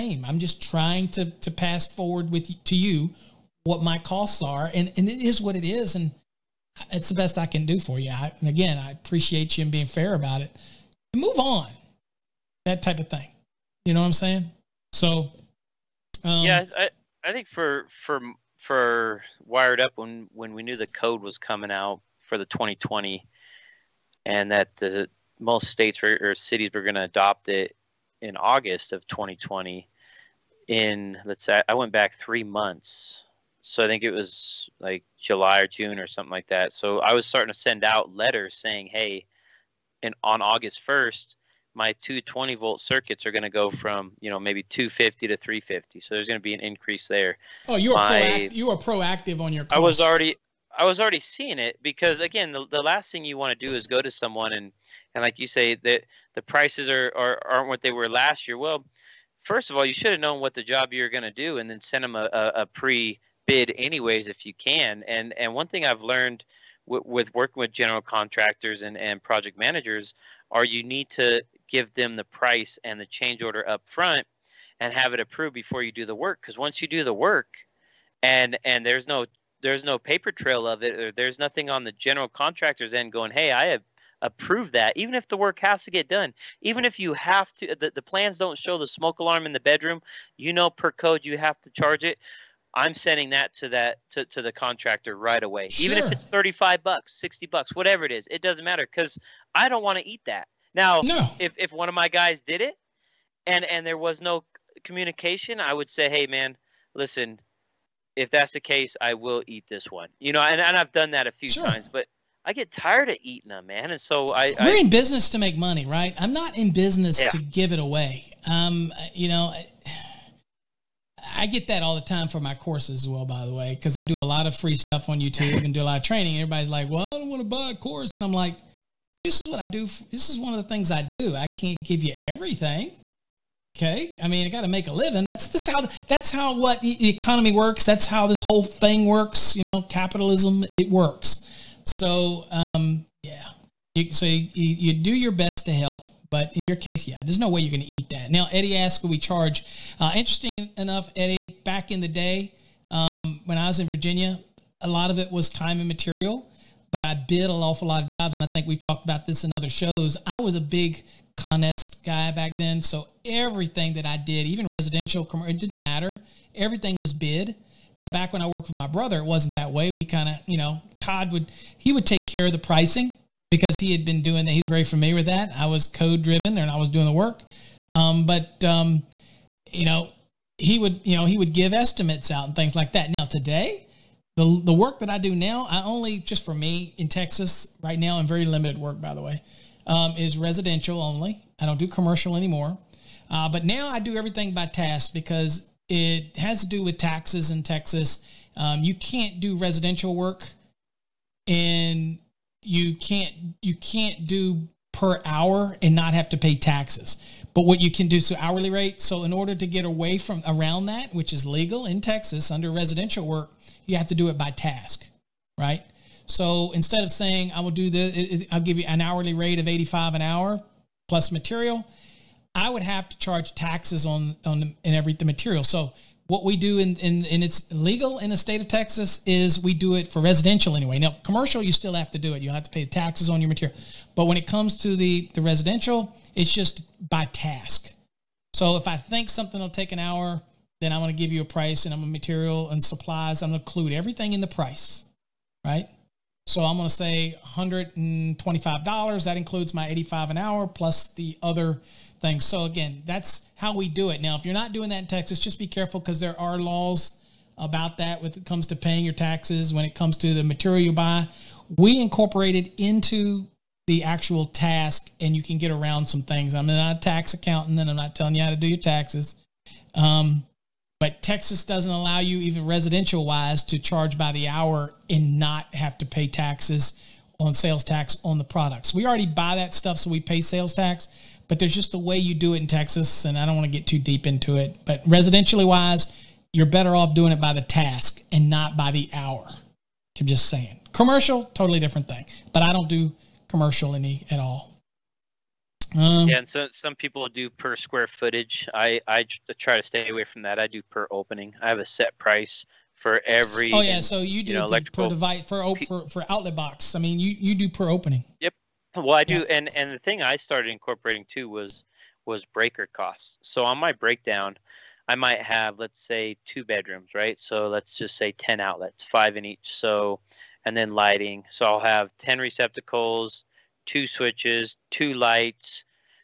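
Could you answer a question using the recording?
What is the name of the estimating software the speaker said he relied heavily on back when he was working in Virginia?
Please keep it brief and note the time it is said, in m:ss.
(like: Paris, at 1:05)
Conest, at 2:41.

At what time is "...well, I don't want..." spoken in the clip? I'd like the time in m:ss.
2:06.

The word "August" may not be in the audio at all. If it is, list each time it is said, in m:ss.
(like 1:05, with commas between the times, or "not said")
0:28, 0:40.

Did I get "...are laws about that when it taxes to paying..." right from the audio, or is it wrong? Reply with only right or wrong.
wrong.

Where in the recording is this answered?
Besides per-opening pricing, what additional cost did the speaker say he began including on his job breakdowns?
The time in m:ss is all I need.
5:12.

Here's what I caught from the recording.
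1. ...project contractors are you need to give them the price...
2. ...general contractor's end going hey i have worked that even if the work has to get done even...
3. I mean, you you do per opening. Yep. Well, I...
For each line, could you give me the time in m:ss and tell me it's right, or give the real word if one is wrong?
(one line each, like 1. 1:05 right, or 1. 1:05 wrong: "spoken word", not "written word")
1. 1:09 wrong: "managers", not "contractors"
2. 1:21 wrong: "approved", not "worked"
3. 5:06 right.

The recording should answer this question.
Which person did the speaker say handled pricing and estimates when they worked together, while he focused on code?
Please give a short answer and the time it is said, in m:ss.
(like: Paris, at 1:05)
Todd, at 2:51.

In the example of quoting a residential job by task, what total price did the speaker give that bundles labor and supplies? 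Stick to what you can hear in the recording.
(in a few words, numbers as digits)
$125.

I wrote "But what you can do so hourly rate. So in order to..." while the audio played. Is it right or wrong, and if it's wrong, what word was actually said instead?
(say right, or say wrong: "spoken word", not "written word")
right.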